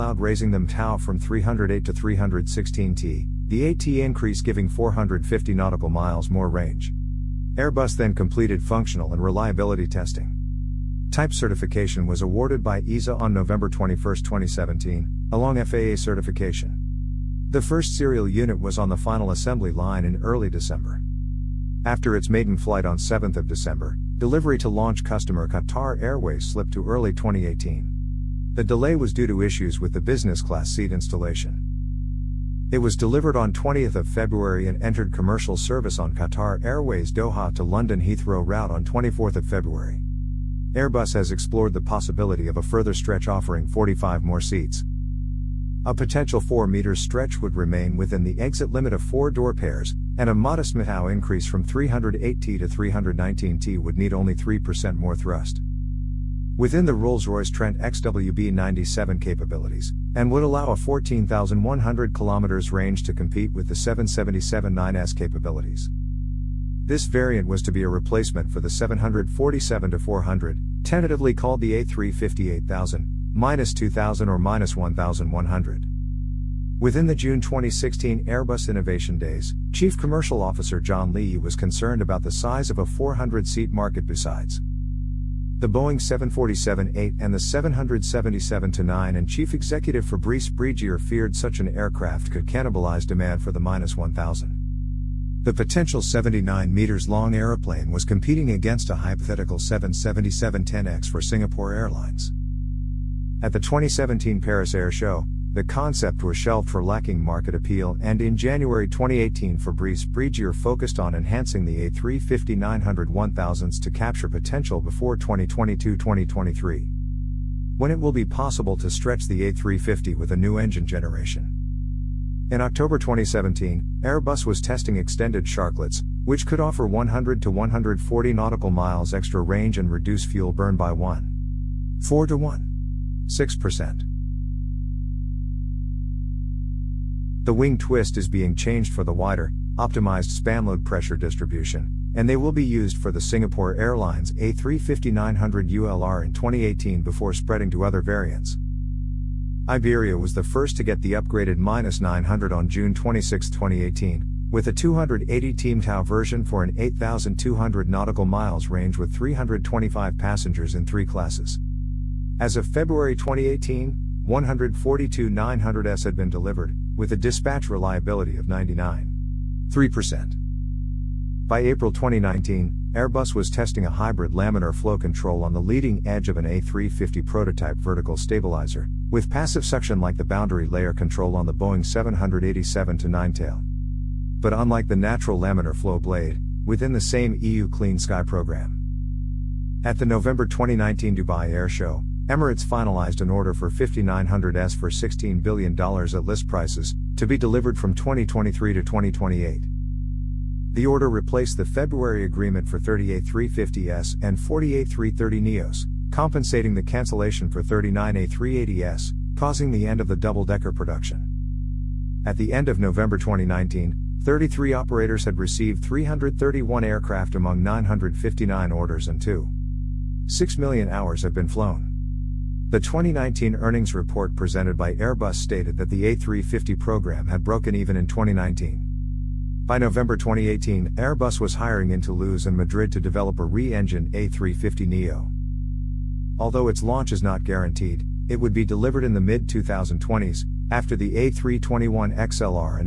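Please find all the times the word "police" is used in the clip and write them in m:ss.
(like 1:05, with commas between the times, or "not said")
not said.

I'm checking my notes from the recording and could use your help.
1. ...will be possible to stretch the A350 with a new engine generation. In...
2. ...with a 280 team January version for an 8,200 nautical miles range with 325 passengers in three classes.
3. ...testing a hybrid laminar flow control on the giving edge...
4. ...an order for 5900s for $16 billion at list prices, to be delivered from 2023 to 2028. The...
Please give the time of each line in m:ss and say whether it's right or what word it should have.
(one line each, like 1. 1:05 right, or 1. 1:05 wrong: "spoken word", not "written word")
1. 1:57 right
2. 2:34 wrong: "Tau", not "January"
3. 2:53 wrong: "leading", not "giving"
4. 3:13 right.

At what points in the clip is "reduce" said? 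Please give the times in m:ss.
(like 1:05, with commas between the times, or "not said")
2:09.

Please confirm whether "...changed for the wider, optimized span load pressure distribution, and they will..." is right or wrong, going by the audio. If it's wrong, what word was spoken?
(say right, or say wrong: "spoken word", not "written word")
right.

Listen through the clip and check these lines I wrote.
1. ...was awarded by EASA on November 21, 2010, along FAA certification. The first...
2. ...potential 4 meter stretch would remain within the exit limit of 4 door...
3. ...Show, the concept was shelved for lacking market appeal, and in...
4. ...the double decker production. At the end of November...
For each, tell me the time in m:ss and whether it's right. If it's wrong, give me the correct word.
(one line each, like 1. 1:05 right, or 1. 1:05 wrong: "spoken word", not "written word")
1. 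0:12 wrong: "2017", not "2010"
2. 0:45 right
3. 1:44 right
4. 3:30 right.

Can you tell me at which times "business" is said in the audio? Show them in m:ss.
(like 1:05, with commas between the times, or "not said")
0:29.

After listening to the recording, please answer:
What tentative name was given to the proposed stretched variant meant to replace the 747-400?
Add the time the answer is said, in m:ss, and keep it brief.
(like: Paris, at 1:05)
A350-8000, at 1:11.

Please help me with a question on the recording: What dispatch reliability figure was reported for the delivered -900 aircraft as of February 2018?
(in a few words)
99.3%.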